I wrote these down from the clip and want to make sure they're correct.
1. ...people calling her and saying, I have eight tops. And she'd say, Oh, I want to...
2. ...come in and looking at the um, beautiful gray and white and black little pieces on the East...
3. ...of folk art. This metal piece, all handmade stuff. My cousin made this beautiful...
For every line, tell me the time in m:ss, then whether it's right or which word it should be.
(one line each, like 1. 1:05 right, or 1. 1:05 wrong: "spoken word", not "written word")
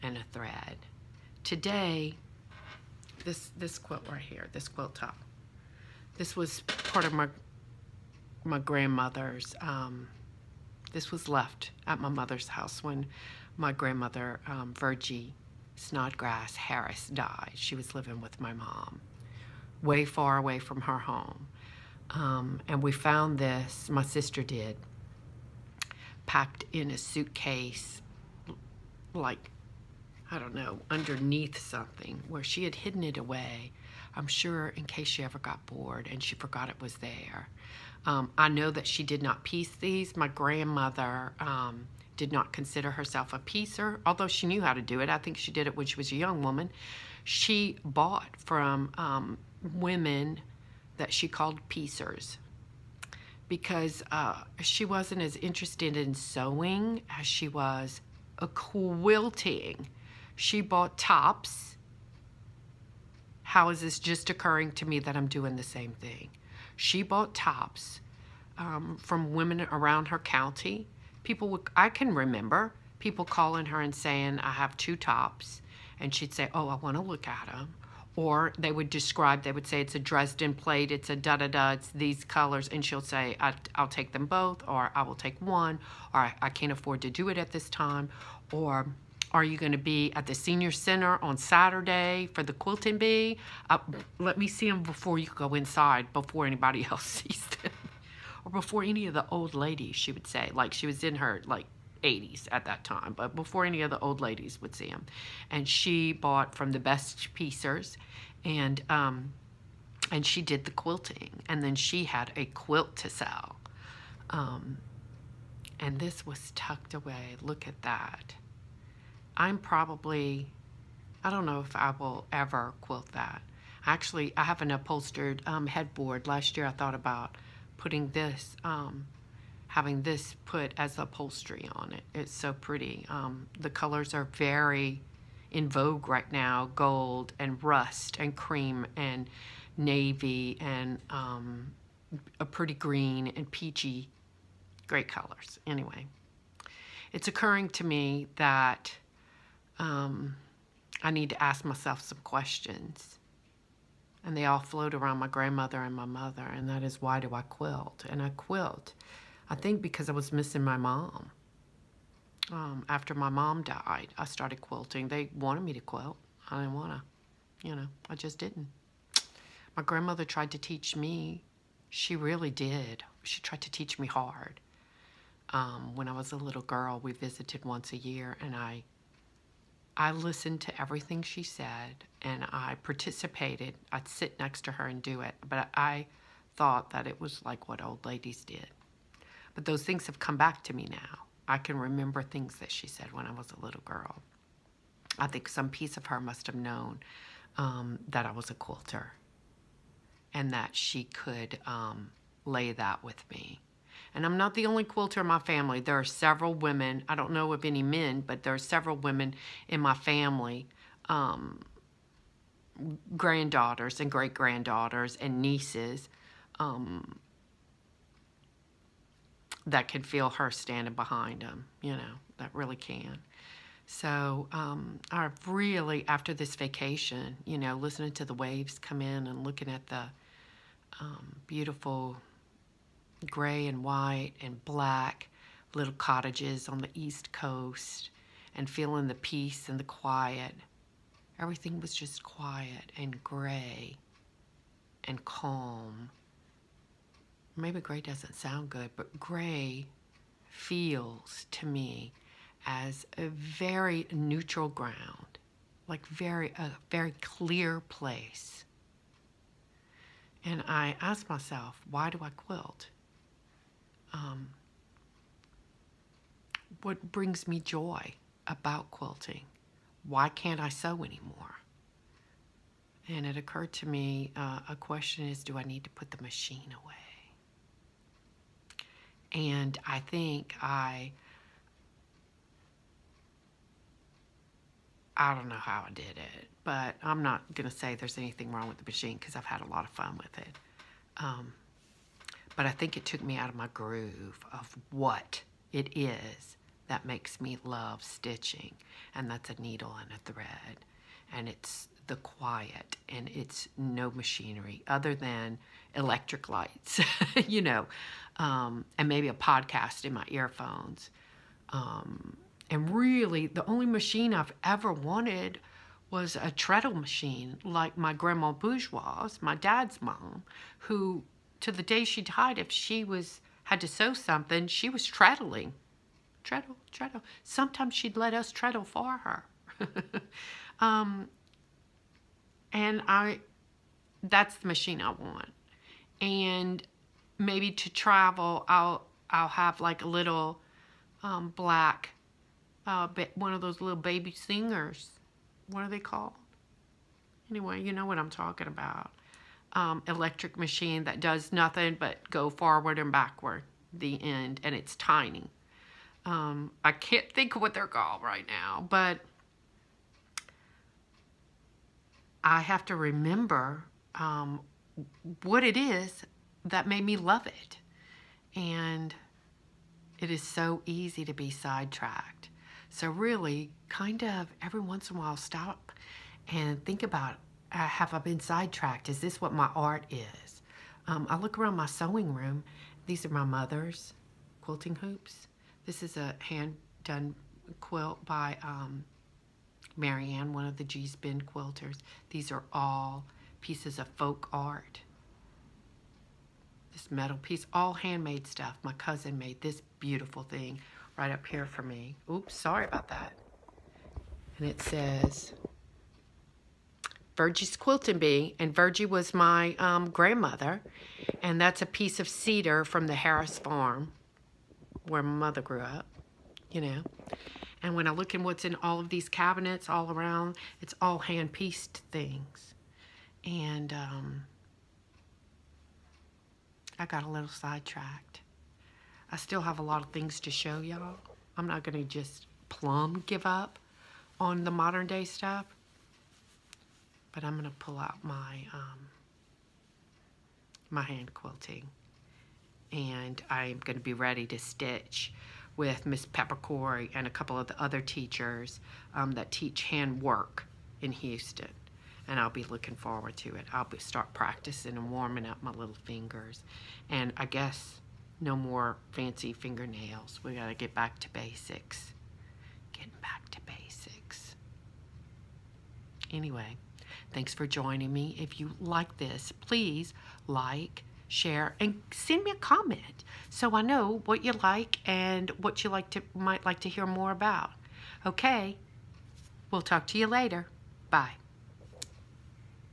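1. 1:12 wrong: "two", not "eight"
2. 3:48 wrong: "cottages", not "pieces"
3. 6:33 right.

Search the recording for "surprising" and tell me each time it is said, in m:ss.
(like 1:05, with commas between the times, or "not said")
not said.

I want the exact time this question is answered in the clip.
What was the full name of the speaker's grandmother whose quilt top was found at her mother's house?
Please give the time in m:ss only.
0:14.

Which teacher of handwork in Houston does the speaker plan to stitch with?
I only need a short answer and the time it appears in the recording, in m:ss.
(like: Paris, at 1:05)
Pepper Cory, at 7:26.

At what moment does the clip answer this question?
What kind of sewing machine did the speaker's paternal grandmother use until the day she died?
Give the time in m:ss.
5:16.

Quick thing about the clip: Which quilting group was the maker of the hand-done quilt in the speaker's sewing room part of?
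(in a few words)
Gee's Bend quilters.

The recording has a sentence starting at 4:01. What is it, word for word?
Everything was just quiet and gray and calm.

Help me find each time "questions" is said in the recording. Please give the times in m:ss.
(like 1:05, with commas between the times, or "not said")
2:32, 4:34.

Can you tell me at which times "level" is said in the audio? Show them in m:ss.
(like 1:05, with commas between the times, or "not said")
not said.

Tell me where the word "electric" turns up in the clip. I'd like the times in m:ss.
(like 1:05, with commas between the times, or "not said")
5:05, 5:50.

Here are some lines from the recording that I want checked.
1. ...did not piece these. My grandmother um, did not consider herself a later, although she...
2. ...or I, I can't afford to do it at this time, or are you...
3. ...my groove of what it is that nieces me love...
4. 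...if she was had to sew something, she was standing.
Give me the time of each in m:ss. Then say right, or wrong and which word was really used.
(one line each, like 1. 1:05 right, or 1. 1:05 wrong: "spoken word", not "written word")
1. 0:39 wrong: "piecer", not "later"
2. 1:26 right
3. 4:53 wrong: "makes", not "nieces"
4. 5:22 wrong: "treadling", not "standing".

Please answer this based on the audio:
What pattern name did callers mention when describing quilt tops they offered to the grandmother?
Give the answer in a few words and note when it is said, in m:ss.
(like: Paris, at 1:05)
Dresden plate, at 1:19.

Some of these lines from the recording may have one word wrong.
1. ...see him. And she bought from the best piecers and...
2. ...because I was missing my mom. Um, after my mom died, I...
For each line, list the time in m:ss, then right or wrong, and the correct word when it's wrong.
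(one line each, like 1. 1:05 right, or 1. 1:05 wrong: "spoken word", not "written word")
1. 1:44 right
2. 2:39 right.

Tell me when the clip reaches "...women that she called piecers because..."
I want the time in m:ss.
0:49.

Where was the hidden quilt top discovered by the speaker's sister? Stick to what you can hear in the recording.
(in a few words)
In a suitcase.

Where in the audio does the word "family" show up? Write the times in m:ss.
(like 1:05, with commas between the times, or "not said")
3:25, 3:29.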